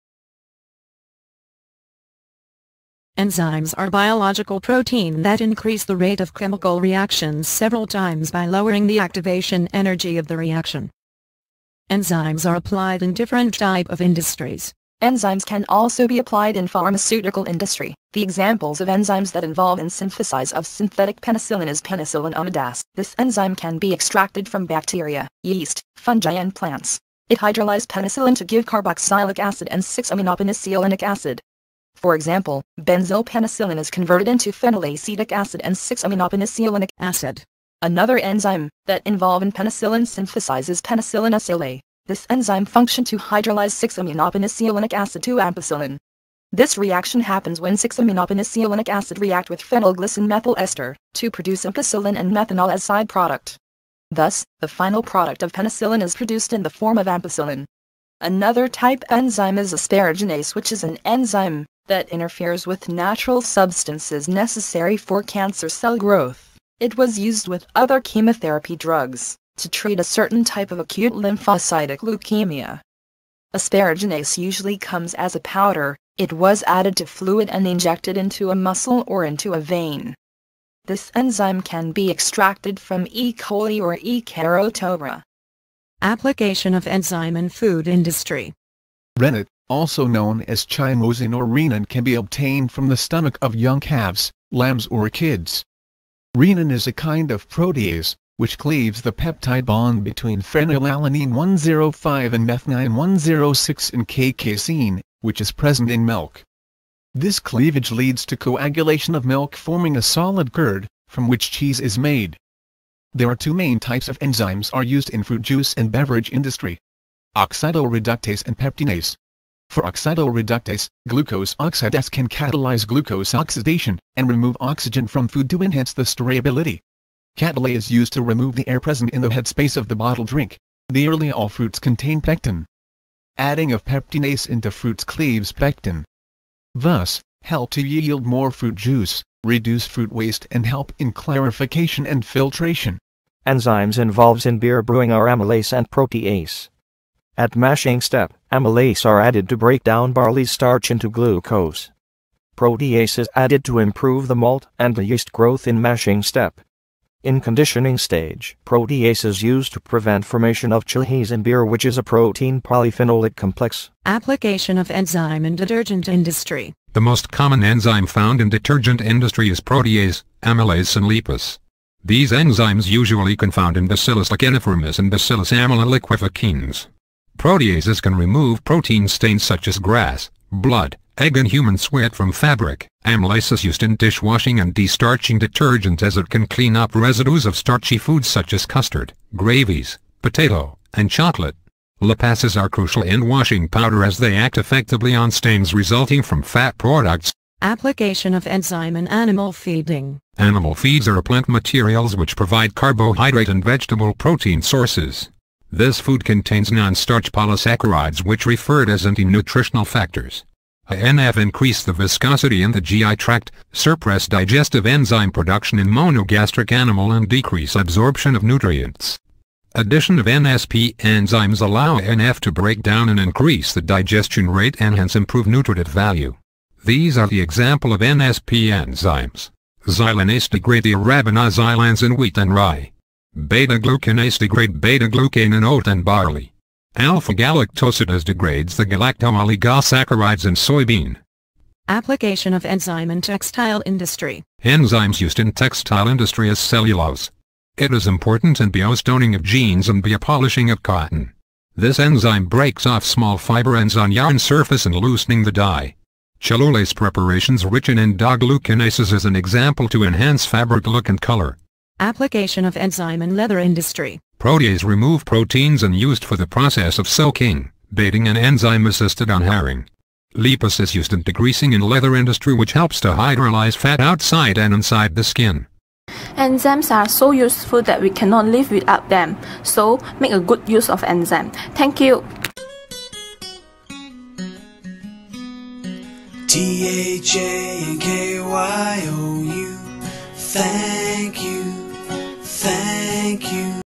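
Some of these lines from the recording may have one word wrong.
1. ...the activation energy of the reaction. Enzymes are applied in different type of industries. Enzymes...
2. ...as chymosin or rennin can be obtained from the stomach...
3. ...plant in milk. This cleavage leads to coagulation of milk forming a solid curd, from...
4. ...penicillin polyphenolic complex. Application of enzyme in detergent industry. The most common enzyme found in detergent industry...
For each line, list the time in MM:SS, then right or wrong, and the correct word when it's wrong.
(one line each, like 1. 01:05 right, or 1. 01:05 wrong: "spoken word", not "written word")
1. 00:08 right
2. 01:30 right
3. 01:45 wrong: "present", not "plant"
4. 02:42 wrong: "protein", not "penicillin".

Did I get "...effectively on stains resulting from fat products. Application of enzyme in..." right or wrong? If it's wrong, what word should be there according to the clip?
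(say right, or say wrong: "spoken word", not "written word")
right.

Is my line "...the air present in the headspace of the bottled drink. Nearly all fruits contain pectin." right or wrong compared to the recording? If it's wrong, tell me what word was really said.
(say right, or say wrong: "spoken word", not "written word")
right.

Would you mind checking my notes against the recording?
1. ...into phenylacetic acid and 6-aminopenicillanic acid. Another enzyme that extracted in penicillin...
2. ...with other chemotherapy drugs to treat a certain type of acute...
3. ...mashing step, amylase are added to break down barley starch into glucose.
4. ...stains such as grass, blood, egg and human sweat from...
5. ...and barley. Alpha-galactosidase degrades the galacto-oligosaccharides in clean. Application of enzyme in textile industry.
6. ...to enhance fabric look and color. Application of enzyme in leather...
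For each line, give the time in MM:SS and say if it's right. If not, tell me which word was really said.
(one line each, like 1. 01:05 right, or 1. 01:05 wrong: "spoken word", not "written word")
1. 00:34 wrong: "involved", not "extracted"
2. 01:07 right
3. 02:27 right
4. 02:59 right
5. 03:55 wrong: "soybean", not "clean"
6. 04:19 right.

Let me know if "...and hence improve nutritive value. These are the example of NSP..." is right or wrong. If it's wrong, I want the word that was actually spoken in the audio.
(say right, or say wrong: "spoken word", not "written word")
right.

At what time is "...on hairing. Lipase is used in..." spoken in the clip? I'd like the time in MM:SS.
04:29.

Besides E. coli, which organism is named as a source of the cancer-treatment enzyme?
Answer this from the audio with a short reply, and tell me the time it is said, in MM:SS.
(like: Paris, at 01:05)
E. carotovora, at 01:23.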